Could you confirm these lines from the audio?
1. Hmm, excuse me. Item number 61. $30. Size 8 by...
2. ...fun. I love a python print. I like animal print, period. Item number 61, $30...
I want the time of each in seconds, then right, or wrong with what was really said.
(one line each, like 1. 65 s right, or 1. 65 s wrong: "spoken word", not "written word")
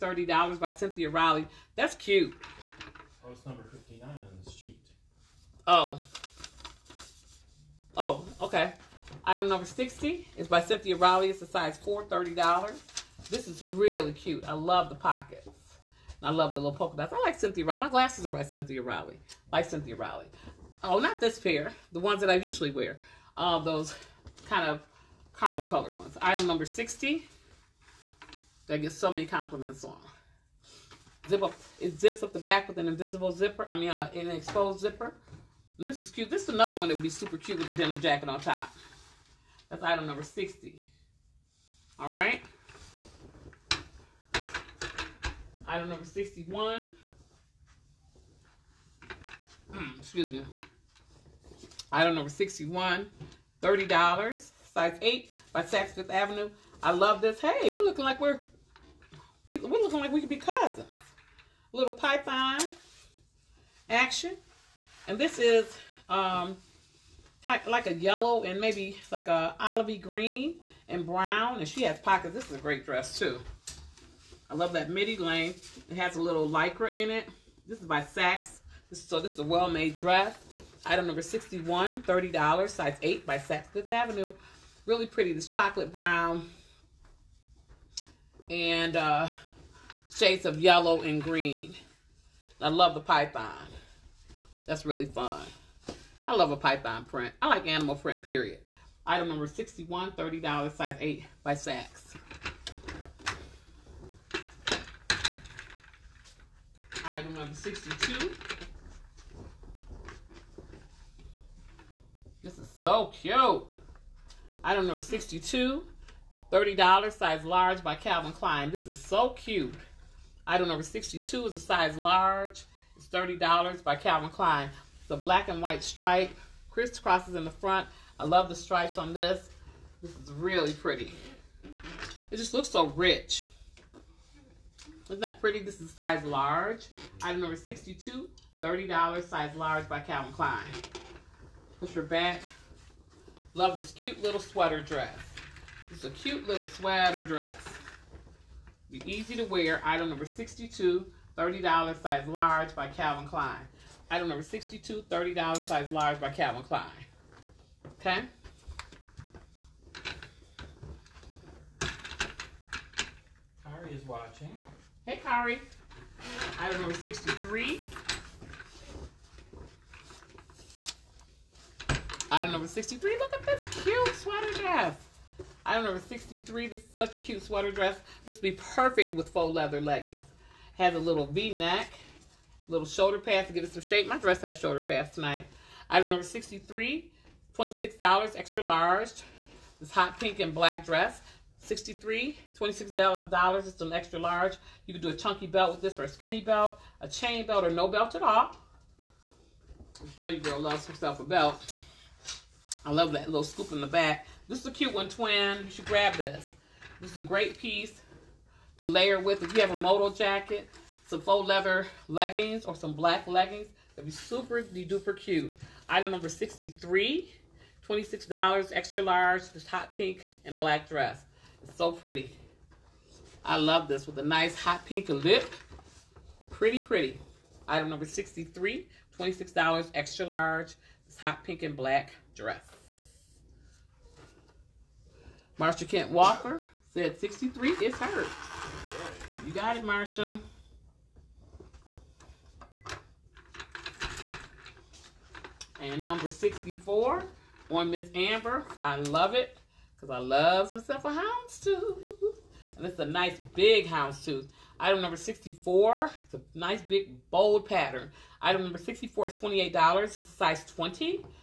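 1. 49 s right
2. 95 s right.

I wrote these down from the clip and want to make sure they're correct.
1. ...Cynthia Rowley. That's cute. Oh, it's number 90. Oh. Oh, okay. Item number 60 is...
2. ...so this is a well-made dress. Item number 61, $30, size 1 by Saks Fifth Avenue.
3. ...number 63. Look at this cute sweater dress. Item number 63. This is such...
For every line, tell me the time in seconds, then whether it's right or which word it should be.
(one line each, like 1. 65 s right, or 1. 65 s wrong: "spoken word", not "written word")
1. 0 s wrong: "50", not "90"
2. 79 s wrong: "8", not "1"
3. 172 s right.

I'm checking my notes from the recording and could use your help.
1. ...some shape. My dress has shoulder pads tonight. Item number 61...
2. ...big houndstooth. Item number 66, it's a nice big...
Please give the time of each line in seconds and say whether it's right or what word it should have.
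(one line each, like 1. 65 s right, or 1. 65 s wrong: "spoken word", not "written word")
1. 183 s wrong: "63", not "61"
2. 253 s wrong: "64", not "66".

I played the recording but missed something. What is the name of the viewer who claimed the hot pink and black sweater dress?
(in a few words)
Marsha Kent Walker.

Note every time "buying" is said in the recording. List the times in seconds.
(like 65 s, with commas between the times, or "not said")
not said.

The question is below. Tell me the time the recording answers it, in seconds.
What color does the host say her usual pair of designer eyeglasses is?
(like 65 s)
25 s.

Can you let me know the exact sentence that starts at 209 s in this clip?
If you have a moto jacket, some faux leather leggings or some black leggings, that'd be super duper cute.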